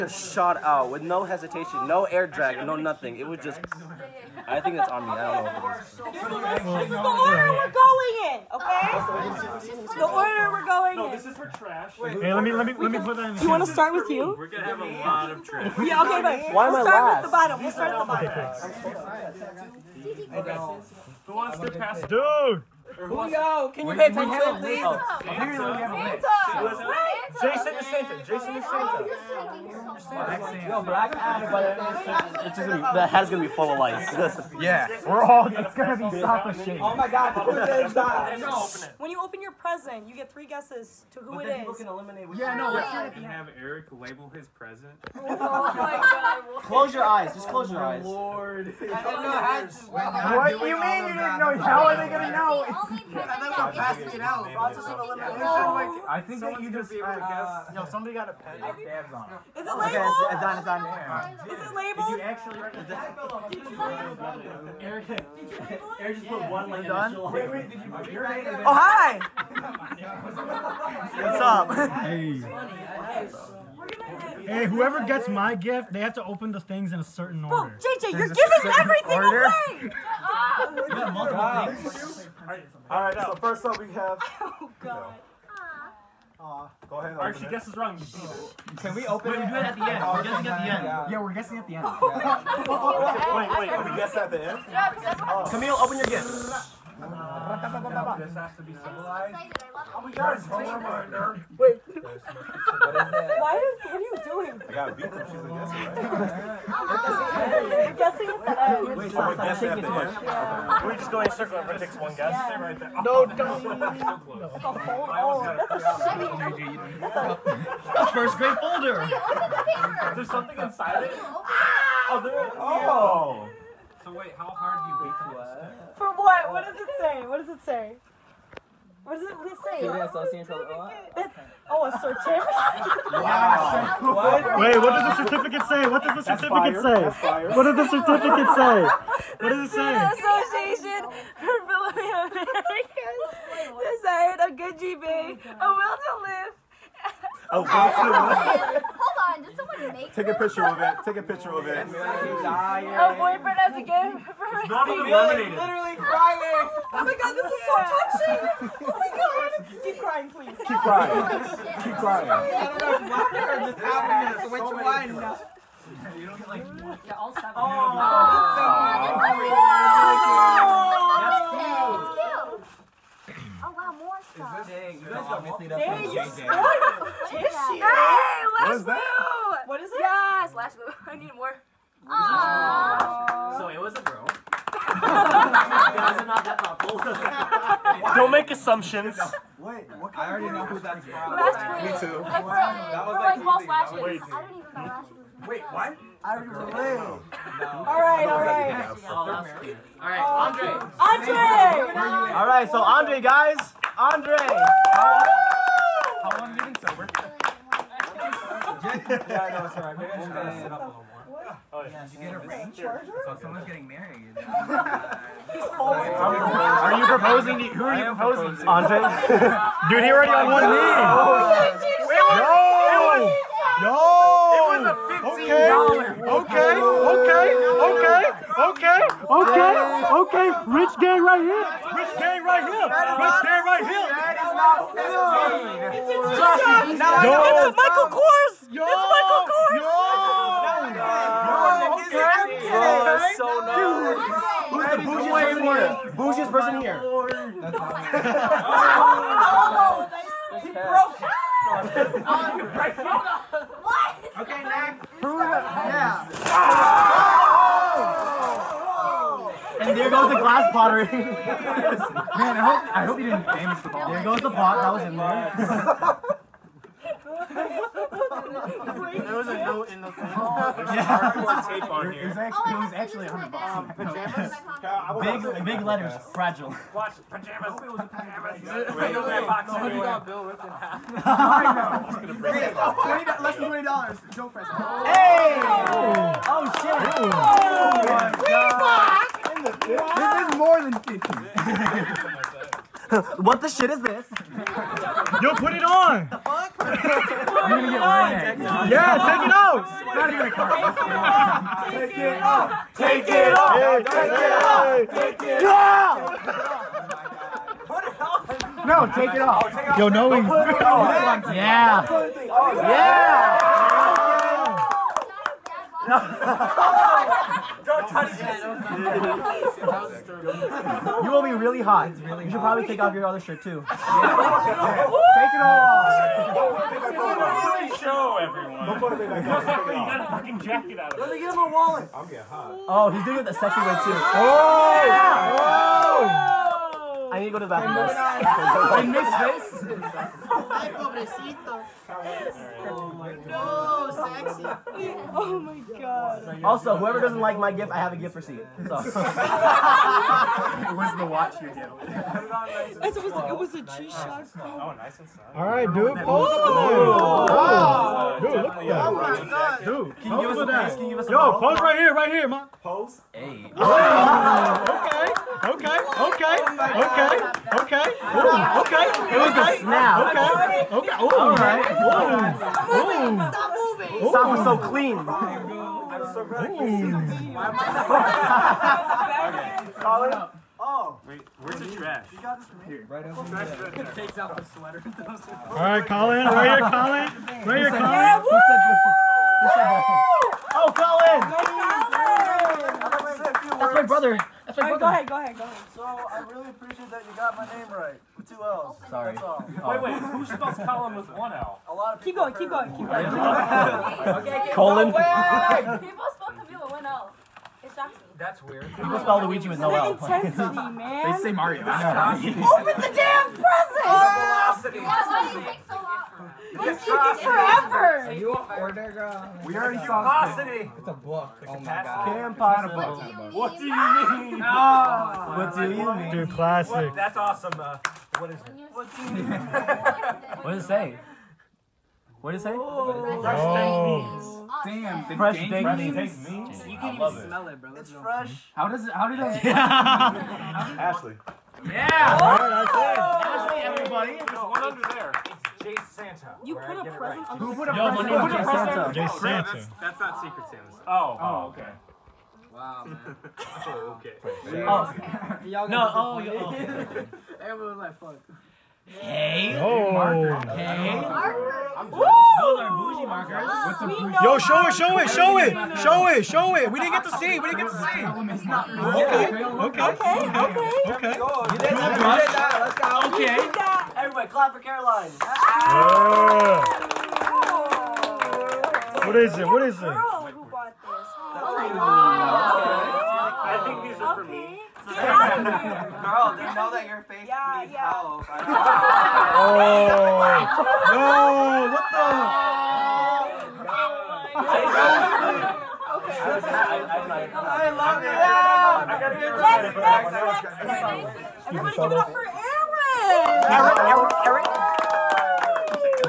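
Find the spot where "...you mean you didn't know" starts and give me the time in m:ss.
0:50.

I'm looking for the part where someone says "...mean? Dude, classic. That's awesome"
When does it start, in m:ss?
7:06.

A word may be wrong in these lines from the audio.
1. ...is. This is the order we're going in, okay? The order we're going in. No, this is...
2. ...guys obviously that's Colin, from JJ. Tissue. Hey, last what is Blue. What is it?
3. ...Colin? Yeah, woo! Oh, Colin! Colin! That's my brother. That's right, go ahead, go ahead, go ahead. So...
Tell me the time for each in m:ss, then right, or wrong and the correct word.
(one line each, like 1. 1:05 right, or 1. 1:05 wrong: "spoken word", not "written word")
1. 0:06 right
2. 2:55 wrong: "Dang", not "Colin"
3. 6:27 right.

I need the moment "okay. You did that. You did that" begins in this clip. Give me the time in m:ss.
7:51.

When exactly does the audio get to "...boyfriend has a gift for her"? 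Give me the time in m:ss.
2:33.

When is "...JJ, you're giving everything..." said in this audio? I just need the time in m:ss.
1:18.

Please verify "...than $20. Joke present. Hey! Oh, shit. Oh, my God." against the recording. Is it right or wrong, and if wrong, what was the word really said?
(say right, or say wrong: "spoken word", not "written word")
right.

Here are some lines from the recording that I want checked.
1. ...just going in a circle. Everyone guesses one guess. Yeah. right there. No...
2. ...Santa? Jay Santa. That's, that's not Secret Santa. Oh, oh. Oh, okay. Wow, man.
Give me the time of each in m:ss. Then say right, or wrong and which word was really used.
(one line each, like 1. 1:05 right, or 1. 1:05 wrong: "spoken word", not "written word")
1. 1:50 wrong: "takes", not "guesses"
2. 7:29 right.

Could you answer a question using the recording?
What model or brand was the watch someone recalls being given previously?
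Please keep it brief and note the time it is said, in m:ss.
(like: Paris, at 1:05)
G-Shock, at 5:53.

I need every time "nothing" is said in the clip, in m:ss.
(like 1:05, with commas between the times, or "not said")
0:02.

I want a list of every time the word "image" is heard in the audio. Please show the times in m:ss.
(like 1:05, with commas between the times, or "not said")
not said.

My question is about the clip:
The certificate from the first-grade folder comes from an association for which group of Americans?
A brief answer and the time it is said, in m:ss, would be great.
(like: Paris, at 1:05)
Filipino, at 2:21.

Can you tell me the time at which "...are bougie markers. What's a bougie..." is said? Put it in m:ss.
7:42.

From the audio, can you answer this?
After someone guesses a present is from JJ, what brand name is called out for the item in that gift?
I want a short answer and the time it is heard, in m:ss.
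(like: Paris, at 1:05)
Lash Blue, at 3:11.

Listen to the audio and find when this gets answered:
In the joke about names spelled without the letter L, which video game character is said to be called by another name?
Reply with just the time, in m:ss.
6:49.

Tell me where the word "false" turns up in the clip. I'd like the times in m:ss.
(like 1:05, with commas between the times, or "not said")
3:13.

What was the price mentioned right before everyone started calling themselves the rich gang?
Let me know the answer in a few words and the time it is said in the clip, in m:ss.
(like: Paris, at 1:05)
$15, at 3:46.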